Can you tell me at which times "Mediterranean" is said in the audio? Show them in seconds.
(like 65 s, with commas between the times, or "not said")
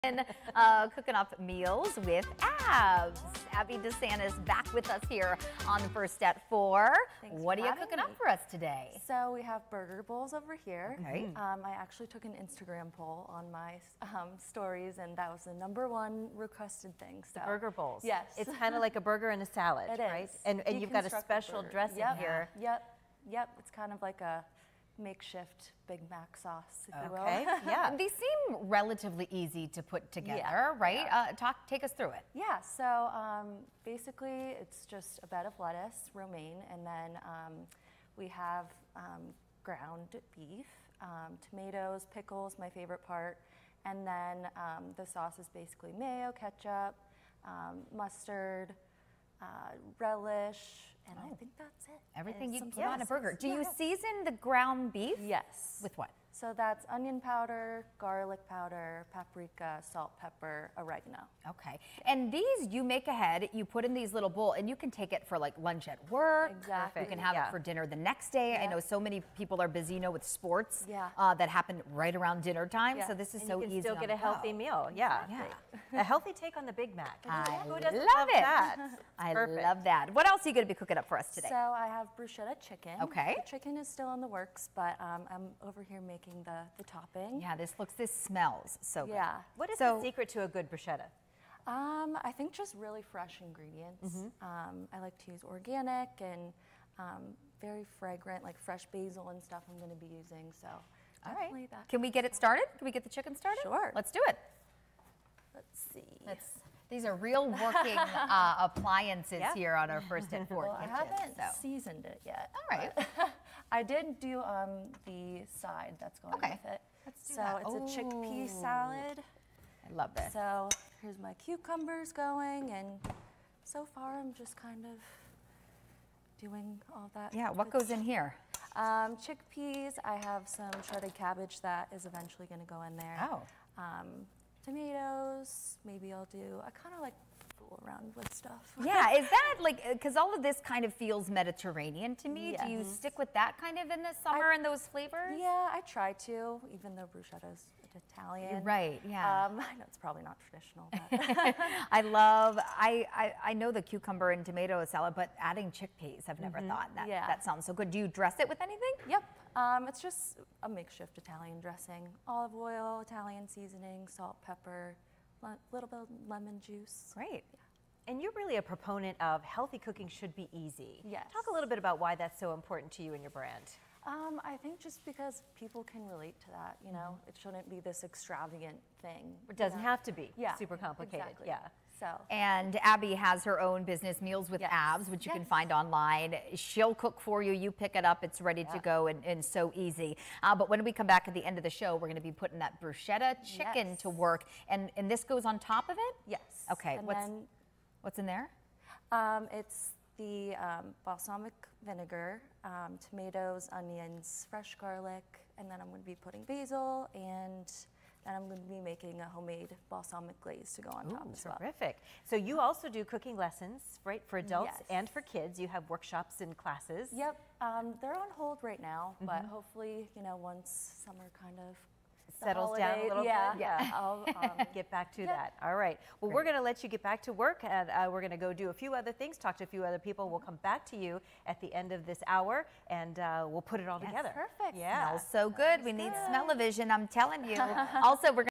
141 s.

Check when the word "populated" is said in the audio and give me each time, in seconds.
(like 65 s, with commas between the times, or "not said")
not said.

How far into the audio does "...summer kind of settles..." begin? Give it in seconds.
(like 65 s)
221 s.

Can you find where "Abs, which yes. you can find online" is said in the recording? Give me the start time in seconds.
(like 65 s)
184 s.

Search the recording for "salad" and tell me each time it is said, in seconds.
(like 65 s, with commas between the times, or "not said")
19 s, 118 s, 154 s.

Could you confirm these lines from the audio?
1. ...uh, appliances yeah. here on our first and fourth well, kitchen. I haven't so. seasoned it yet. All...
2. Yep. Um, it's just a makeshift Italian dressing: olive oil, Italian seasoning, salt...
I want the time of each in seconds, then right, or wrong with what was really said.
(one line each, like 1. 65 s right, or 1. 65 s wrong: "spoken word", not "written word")
1. 108 s right
2. 159 s right.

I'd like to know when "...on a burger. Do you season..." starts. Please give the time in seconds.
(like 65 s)
52 s.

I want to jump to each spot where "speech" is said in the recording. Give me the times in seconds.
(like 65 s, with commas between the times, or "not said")
not said.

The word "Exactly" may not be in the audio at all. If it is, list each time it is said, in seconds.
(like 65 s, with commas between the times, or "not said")
66 s, 181 s.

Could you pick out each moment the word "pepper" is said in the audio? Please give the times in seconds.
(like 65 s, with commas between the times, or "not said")
60 s, 164 s.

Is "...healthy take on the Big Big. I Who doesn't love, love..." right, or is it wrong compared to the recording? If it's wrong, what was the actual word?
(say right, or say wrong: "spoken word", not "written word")
wrong: "Mac", not "Big".